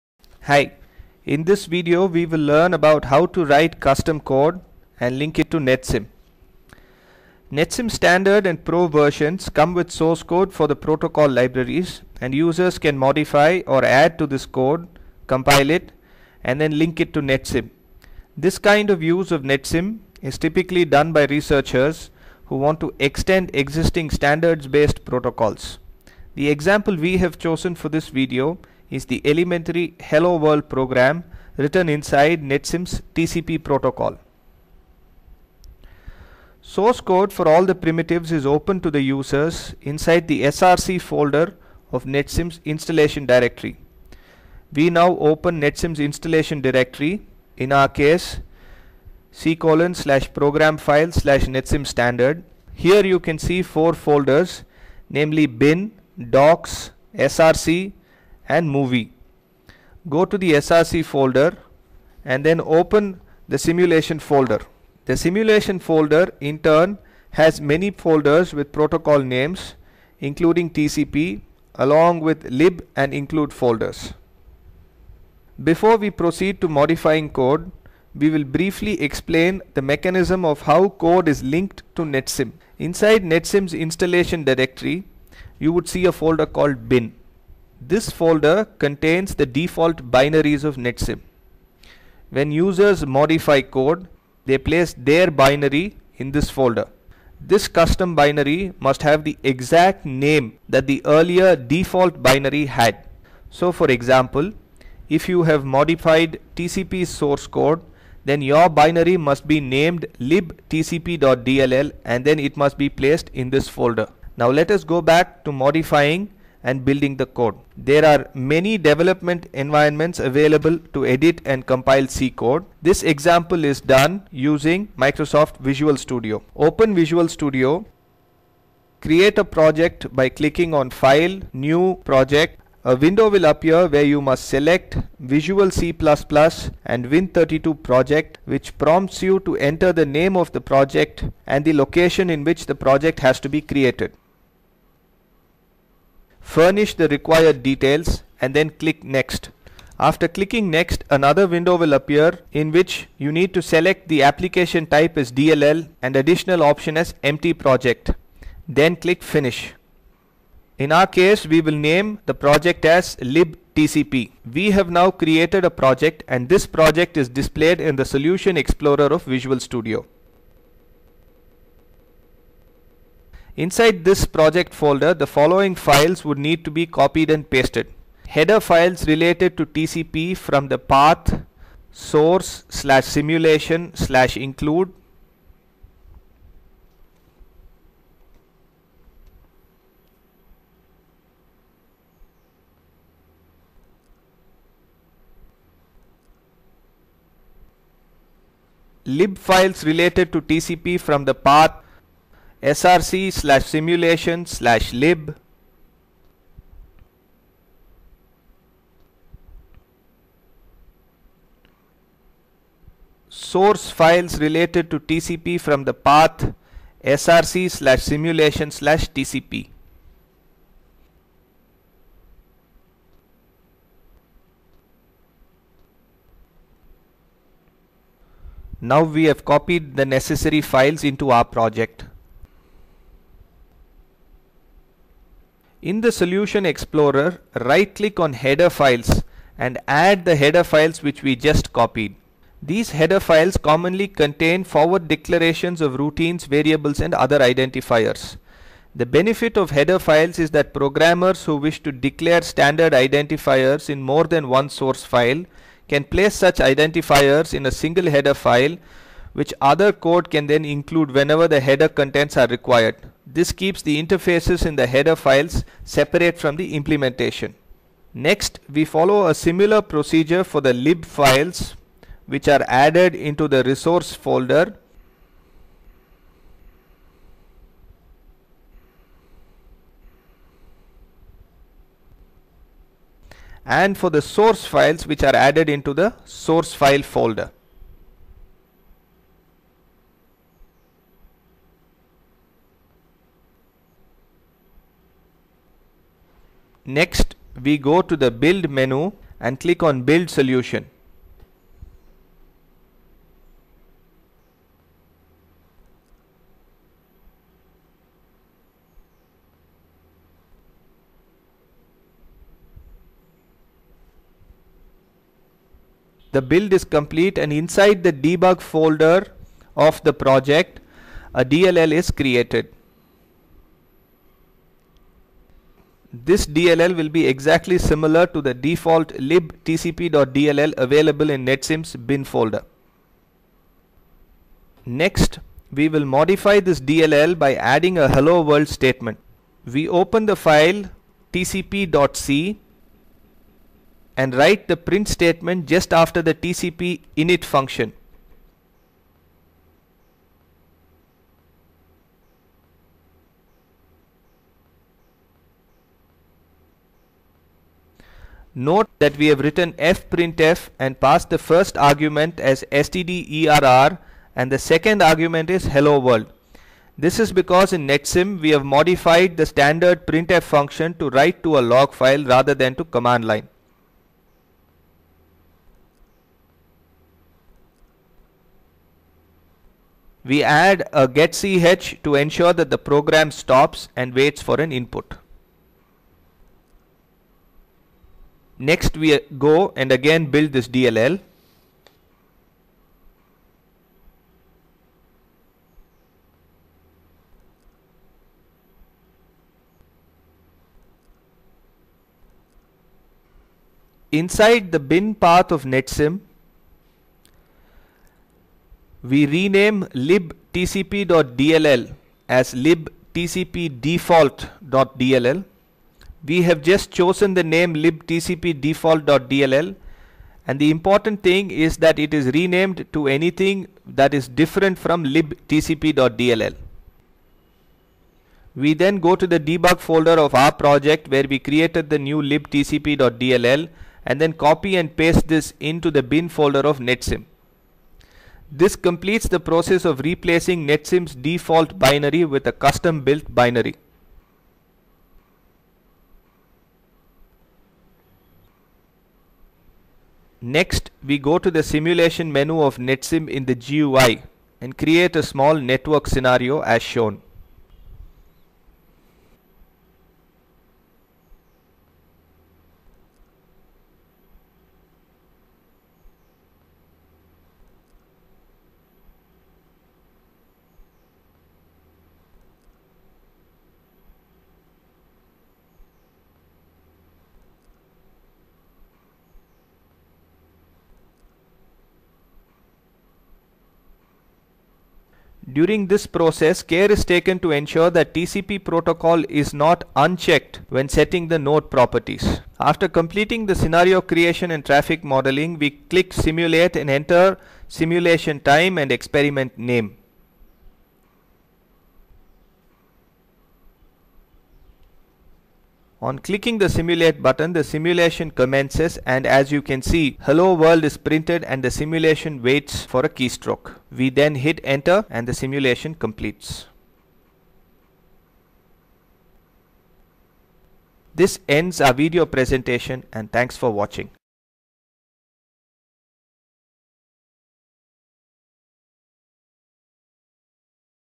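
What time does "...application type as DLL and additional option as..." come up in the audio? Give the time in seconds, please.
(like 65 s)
154 s.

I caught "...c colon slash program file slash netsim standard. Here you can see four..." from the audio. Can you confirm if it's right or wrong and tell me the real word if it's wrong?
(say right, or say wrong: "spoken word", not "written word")
right.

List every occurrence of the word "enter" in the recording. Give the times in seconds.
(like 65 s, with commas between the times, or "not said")
139 s, 496 s, 514 s.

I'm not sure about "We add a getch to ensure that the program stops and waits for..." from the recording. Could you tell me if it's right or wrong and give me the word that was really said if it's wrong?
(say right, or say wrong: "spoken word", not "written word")
right.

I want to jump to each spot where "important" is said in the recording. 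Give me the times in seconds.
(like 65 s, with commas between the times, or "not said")
420 s.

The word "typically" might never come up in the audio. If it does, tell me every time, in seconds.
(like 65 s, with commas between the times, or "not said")
20 s.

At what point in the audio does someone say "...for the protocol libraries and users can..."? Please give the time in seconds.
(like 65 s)
10 s.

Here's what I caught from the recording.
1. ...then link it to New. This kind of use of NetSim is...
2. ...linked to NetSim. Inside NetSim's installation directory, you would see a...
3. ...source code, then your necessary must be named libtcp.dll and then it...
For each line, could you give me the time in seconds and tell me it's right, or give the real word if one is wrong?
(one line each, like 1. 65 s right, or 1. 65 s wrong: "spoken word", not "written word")
1. 16 s wrong: "NetSim", not "New"
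2. 81 s right
3. 107 s wrong: "binary", not "necessary".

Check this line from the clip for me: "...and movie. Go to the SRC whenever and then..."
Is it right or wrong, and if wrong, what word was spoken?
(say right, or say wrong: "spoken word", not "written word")
wrong: "folder", not "whenever".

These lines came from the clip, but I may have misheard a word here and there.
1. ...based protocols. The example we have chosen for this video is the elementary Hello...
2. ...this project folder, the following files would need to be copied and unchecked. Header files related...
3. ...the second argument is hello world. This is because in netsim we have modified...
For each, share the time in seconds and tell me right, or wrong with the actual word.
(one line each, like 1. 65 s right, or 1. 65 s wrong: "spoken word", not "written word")
1. 24 s right
2. 174 s wrong: "pasted", not "unchecked"
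3. 364 s right.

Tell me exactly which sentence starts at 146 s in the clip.
Furnish the required details and then click next.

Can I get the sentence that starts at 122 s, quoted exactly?
This example is done using Microsoft Visual Studio.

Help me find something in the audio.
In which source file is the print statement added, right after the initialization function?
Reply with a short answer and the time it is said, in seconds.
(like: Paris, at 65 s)
tcp.c, at 341 s.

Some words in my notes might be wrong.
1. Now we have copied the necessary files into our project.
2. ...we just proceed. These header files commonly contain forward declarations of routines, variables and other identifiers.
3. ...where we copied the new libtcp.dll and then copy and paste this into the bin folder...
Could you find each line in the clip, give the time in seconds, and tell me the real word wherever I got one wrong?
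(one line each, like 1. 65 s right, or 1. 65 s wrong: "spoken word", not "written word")
1. 228 s right
2. 241 s wrong: "copied", not "proceed"
3. 431 s wrong: "created", not "copied".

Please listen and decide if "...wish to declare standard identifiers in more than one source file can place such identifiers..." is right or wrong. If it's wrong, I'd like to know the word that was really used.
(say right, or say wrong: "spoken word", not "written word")
right.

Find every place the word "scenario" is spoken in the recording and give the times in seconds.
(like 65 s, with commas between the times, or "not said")
456 s, 493 s.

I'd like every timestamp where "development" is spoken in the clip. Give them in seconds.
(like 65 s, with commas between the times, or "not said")
118 s.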